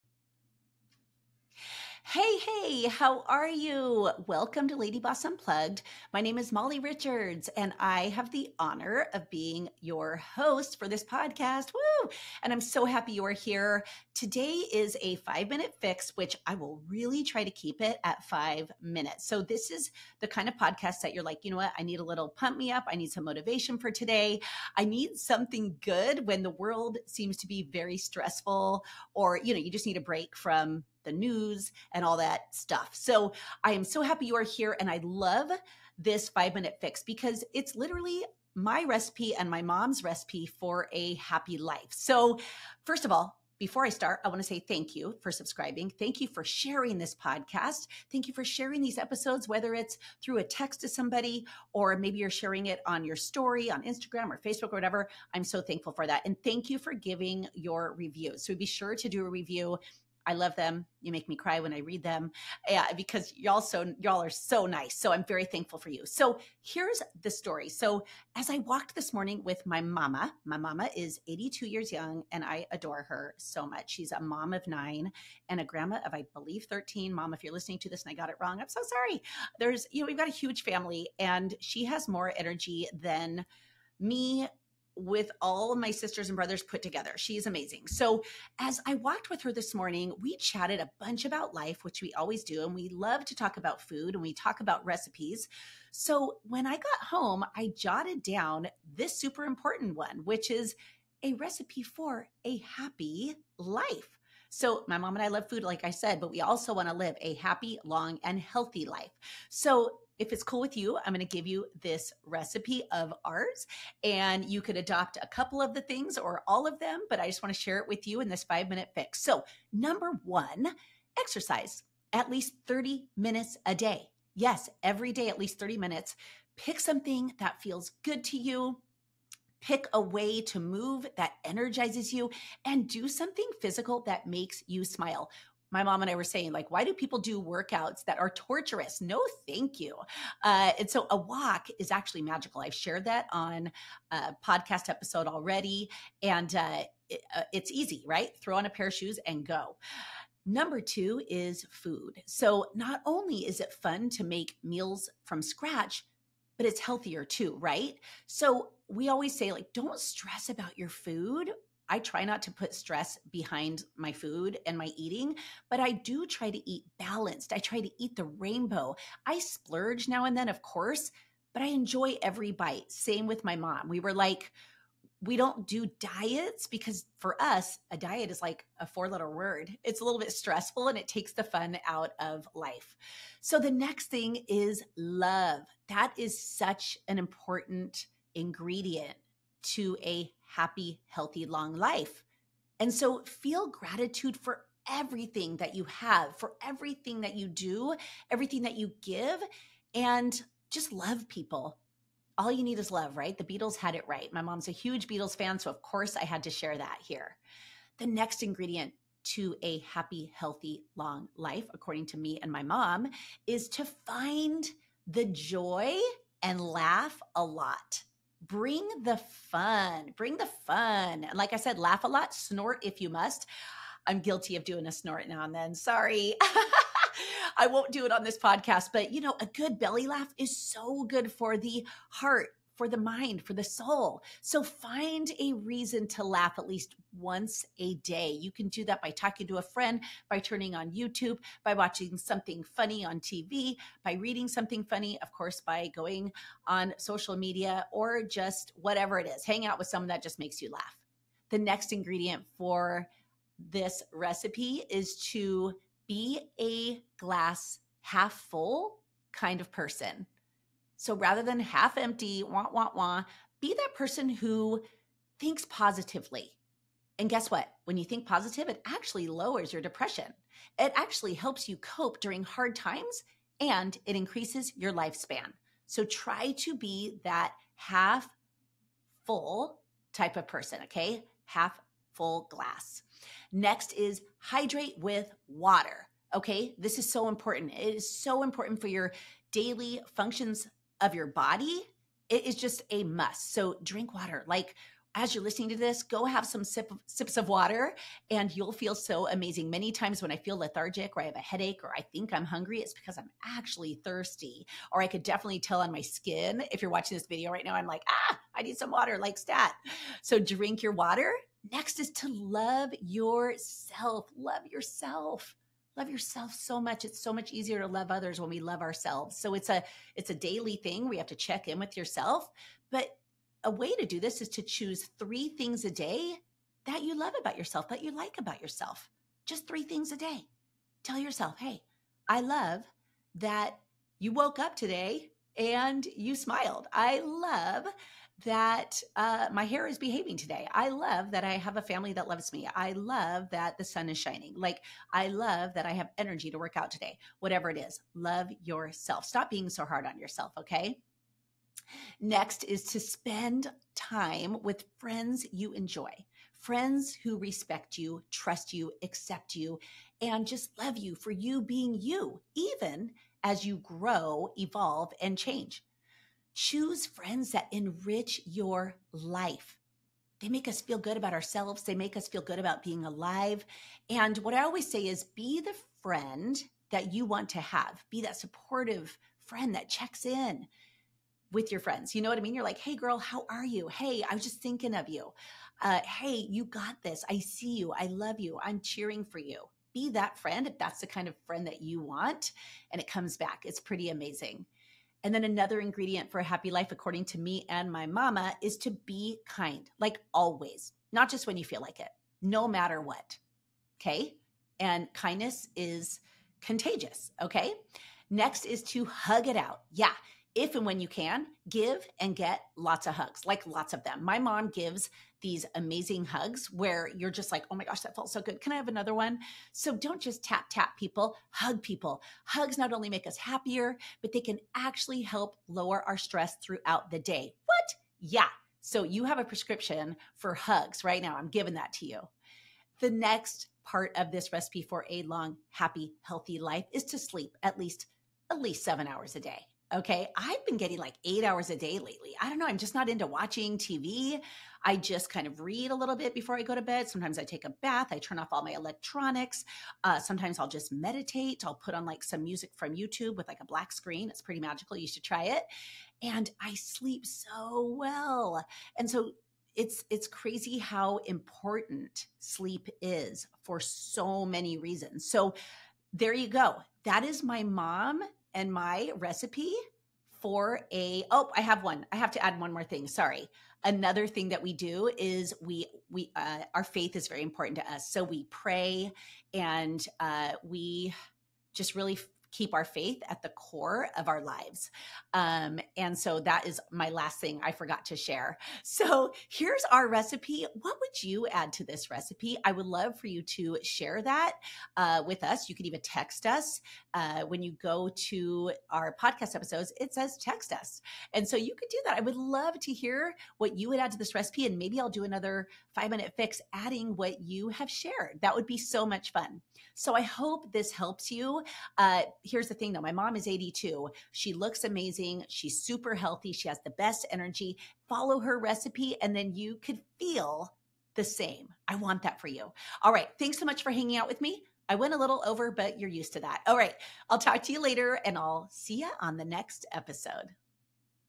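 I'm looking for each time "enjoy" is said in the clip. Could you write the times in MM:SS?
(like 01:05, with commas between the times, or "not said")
02:51, 05:55.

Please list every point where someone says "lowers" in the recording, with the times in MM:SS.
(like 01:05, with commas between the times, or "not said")
04:29, 07:05.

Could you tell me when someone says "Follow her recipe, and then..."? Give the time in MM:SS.
08:38.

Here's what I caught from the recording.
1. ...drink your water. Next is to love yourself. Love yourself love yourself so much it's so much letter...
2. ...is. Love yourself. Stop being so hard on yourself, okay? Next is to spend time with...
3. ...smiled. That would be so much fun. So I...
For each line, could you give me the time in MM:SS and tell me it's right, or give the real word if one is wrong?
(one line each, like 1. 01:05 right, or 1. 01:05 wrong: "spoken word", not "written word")
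1. 05:10 wrong: "easier", not "letter"
2. 05:47 right
3. 08:27 wrong: "shared", not "smiled".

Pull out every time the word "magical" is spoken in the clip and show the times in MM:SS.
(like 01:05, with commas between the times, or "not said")
02:22, 07:34.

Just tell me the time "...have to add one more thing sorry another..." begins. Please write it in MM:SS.
07:52.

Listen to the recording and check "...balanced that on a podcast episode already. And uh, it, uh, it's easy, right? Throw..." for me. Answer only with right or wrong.
wrong.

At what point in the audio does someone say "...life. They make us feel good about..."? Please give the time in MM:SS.
06:09.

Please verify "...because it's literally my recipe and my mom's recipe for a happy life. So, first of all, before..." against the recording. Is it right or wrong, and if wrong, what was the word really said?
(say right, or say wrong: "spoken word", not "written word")
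right.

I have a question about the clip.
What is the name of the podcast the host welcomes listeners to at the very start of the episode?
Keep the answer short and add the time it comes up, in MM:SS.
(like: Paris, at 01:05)
LadyBoss Unplugged, at 00:04.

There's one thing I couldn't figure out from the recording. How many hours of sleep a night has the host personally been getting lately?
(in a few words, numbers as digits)
8.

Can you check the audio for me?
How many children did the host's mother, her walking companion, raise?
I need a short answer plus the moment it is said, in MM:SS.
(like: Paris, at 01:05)
9, at 01:14.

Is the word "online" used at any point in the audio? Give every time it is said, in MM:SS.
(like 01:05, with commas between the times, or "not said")
not said.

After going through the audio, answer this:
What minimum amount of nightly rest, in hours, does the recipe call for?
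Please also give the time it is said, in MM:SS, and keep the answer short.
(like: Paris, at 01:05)
7, at 07:18.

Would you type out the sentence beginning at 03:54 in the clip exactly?
So find a reason to laugh at least once a day.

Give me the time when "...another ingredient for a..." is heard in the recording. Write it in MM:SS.
06:35.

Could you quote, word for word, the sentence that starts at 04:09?
Hang out with someone that just makes you laugh.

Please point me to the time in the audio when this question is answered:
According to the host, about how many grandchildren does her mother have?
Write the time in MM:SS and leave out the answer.
01:16.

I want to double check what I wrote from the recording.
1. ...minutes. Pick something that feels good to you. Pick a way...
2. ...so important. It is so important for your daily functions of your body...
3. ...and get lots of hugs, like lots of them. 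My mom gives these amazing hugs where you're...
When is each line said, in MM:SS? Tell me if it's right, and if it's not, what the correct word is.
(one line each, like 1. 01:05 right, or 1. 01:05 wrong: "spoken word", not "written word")
1. 02:05 right
2. 04:47 right
3. 06:52 right.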